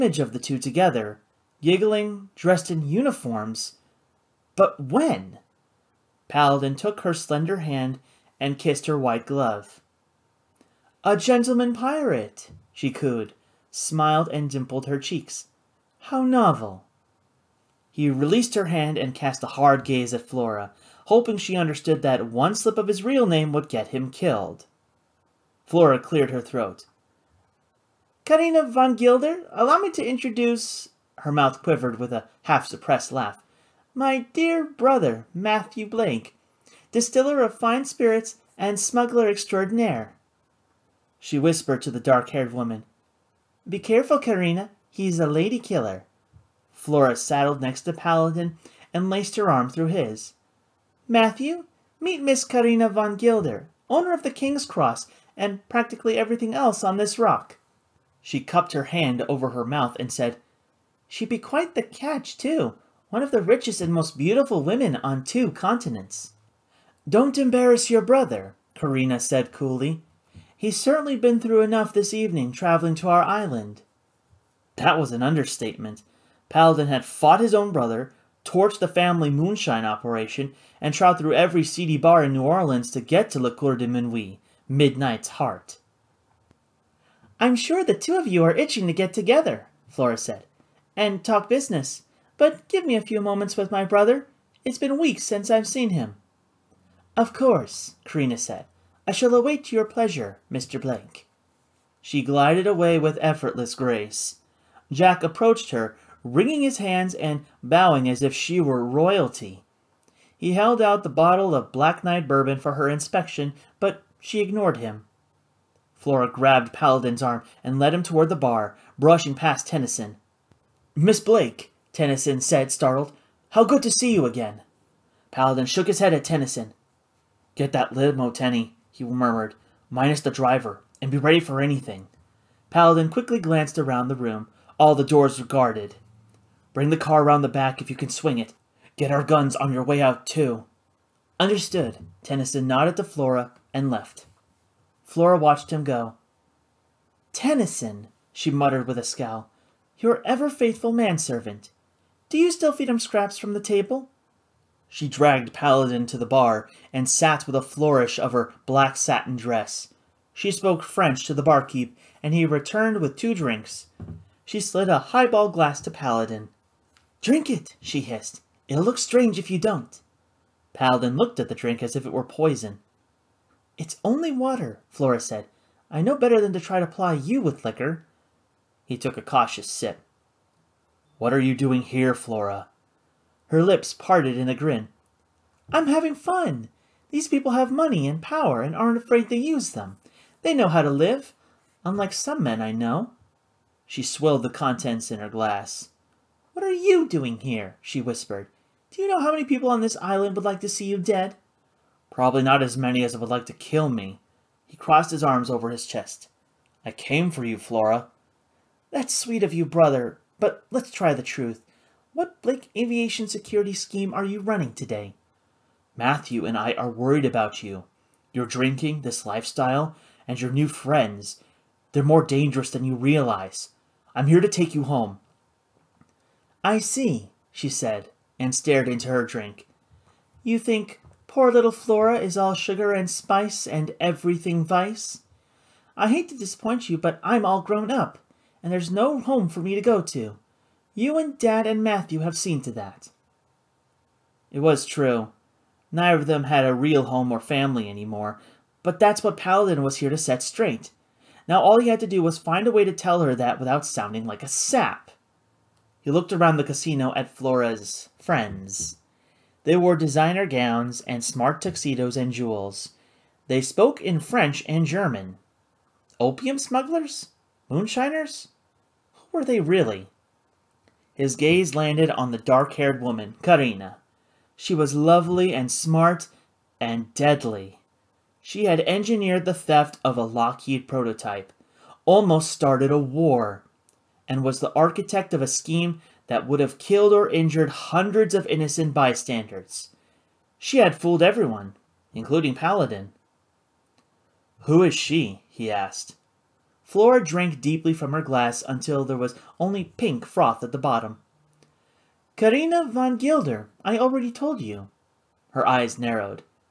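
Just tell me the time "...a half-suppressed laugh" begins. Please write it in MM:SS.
00:32.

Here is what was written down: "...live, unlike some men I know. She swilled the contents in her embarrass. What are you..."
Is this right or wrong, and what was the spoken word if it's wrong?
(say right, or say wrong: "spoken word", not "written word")
wrong: "glass", not "embarrass".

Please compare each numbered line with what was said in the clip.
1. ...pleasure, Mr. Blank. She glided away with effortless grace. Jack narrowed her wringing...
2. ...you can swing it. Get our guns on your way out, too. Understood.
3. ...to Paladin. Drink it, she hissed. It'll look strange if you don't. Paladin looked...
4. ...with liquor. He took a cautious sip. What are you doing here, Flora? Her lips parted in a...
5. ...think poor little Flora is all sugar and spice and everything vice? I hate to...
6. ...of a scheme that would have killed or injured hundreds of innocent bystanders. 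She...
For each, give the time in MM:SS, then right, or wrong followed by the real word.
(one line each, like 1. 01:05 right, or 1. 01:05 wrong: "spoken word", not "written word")
1. 01:39 wrong: "approached", not "narrowed"
2. 02:17 right
3. 02:45 right
4. 02:57 right
5. 03:50 right
6. 04:45 right.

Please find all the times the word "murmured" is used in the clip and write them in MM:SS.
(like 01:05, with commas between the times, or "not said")
02:09.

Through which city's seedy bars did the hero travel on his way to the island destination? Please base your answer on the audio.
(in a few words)
New Orleans.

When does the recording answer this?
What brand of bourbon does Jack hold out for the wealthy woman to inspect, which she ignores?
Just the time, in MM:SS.
01:51.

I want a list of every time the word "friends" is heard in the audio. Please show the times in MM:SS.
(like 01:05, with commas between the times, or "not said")
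03:40, 04:18.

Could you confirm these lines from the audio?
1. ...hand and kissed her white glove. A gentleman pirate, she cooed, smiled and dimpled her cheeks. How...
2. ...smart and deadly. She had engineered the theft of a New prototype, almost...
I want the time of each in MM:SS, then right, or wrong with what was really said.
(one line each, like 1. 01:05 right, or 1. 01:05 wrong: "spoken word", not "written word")
1. 00:07 right
2. 04:35 wrong: "Lockheed", not "New".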